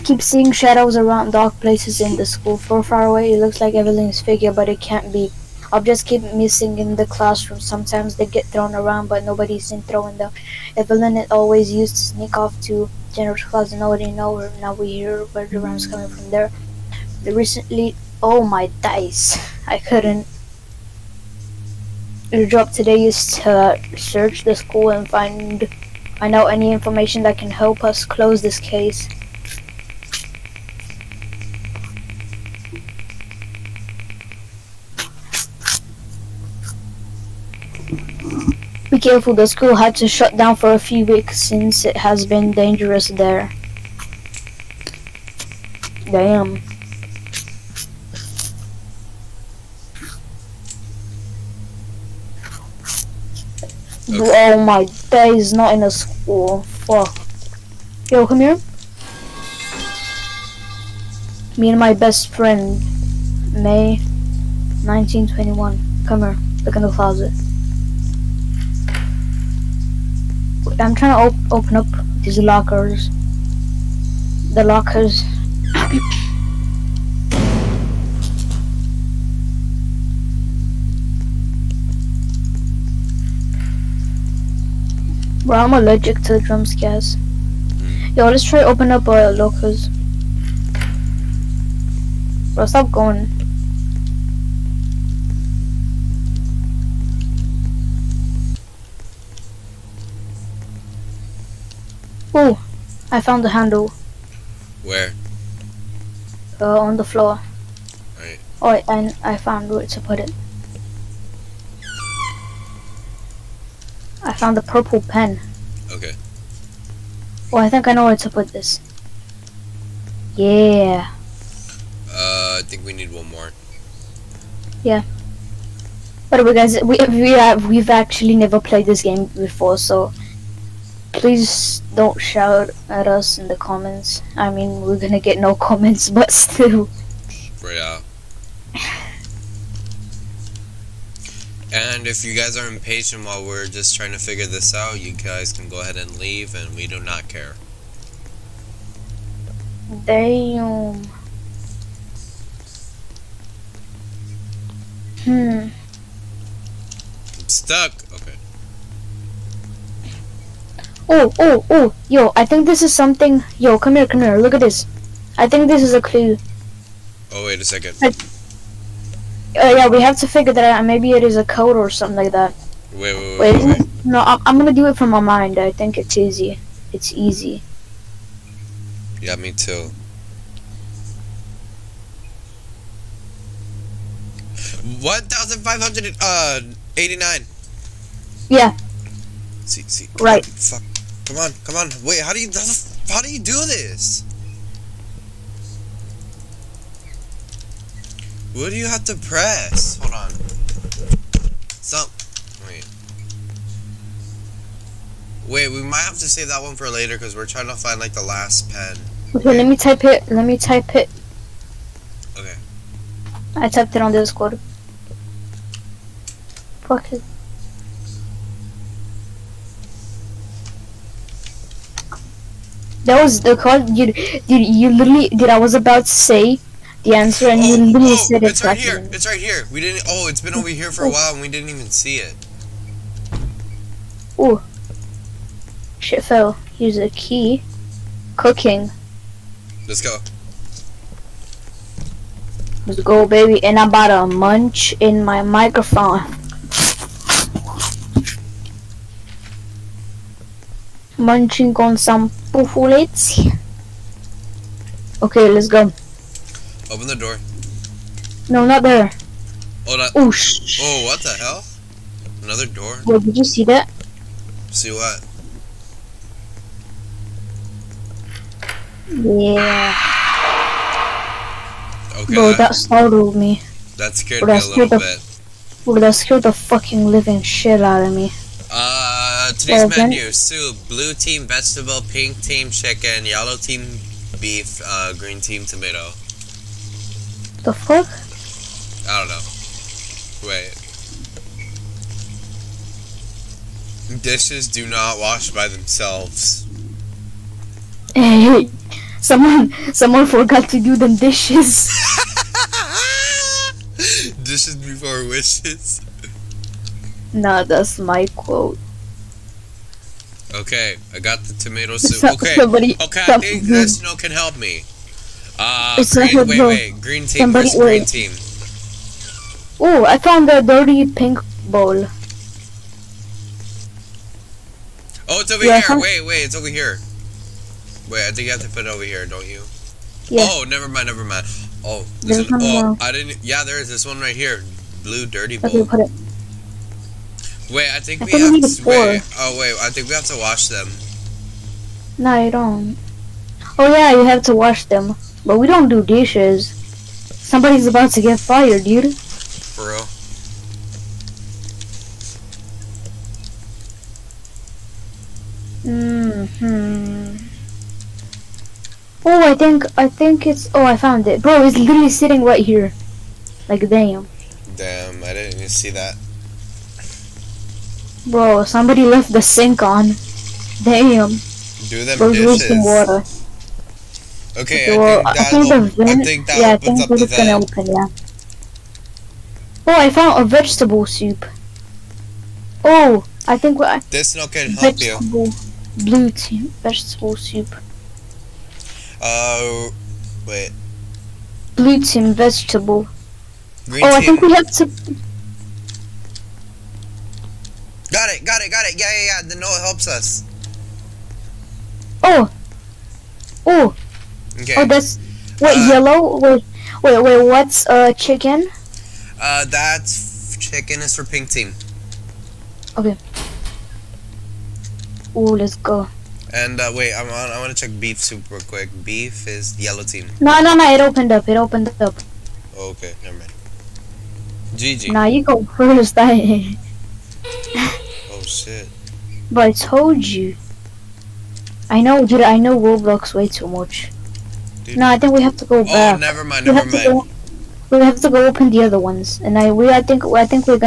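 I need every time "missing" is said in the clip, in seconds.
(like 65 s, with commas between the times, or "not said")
6 s.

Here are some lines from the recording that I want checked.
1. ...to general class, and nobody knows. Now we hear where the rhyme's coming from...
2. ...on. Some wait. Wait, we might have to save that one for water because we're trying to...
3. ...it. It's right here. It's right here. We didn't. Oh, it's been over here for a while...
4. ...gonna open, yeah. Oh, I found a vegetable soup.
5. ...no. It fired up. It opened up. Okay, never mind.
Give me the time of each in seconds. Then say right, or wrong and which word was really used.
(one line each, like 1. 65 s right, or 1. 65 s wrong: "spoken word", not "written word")
1. 12 s right
2. 200 s wrong: "later", not "water"
3. 228 s right
4. 377 s right
5. 420 s wrong: "opened", not "fired".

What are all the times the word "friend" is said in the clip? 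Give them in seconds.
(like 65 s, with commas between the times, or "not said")
62 s.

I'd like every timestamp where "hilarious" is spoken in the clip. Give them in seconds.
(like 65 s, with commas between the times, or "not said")
not said.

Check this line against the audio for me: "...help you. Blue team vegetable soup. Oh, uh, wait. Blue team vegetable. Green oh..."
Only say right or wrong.
right.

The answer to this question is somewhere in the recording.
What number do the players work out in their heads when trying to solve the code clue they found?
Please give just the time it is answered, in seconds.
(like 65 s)
185 s.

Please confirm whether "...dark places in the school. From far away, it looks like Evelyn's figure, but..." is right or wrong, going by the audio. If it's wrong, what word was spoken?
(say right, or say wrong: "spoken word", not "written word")
right.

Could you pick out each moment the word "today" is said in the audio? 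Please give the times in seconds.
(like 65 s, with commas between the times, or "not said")
22 s, 279 s.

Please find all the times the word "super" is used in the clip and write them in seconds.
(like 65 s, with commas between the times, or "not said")
418 s.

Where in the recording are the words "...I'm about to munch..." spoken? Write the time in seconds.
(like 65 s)
243 s.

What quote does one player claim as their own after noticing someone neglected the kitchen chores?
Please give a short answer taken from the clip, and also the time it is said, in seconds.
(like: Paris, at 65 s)
Dishes before wishes, at 304 s.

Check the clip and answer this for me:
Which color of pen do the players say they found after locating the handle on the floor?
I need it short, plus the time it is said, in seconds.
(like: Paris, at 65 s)
Purple, at 114 s.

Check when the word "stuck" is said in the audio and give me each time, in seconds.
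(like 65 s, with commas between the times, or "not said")
157 s.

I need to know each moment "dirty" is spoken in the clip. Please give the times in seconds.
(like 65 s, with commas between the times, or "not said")
320 s, 335 s.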